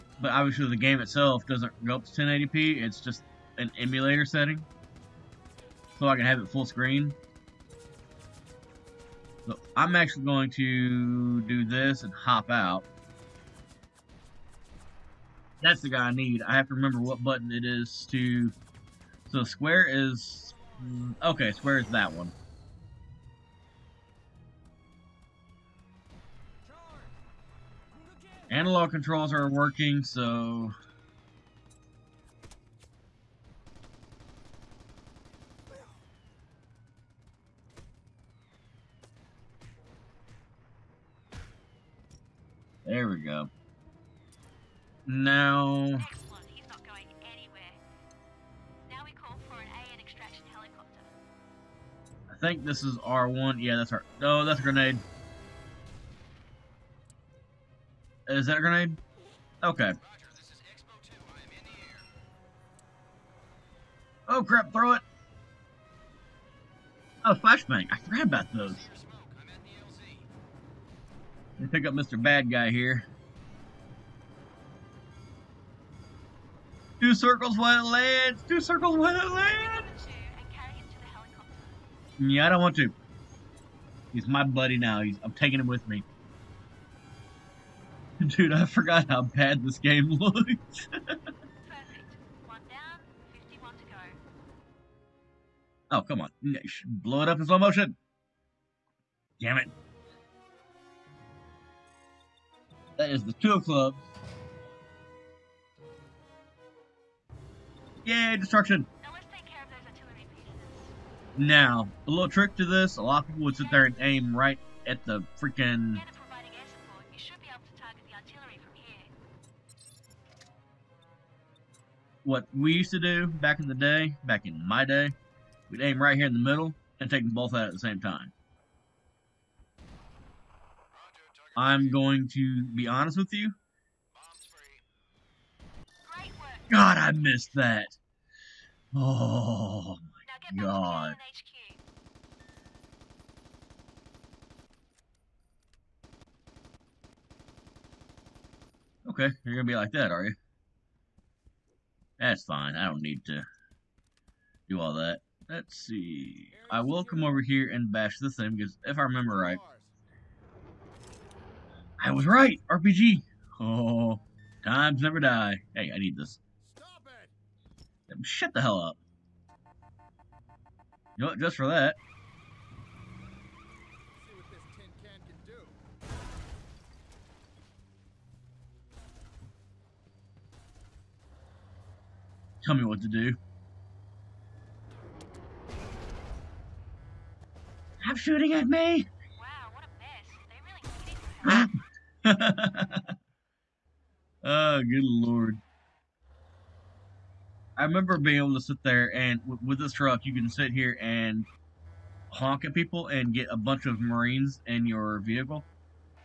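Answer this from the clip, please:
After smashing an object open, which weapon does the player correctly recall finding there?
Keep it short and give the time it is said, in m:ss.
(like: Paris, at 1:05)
RPG, at 2:42.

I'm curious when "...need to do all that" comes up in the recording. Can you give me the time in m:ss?
2:33.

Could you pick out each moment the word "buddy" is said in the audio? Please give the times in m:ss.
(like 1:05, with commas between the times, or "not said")
1:24.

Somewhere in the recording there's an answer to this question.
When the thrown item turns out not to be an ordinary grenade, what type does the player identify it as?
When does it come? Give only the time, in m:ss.
1:07.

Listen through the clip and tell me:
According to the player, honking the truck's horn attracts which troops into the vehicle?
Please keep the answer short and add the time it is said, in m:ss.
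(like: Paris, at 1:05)
Marines, at 3:23.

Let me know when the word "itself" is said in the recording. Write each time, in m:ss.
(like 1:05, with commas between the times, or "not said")
0:00.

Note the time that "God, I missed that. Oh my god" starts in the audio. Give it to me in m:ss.
2:16.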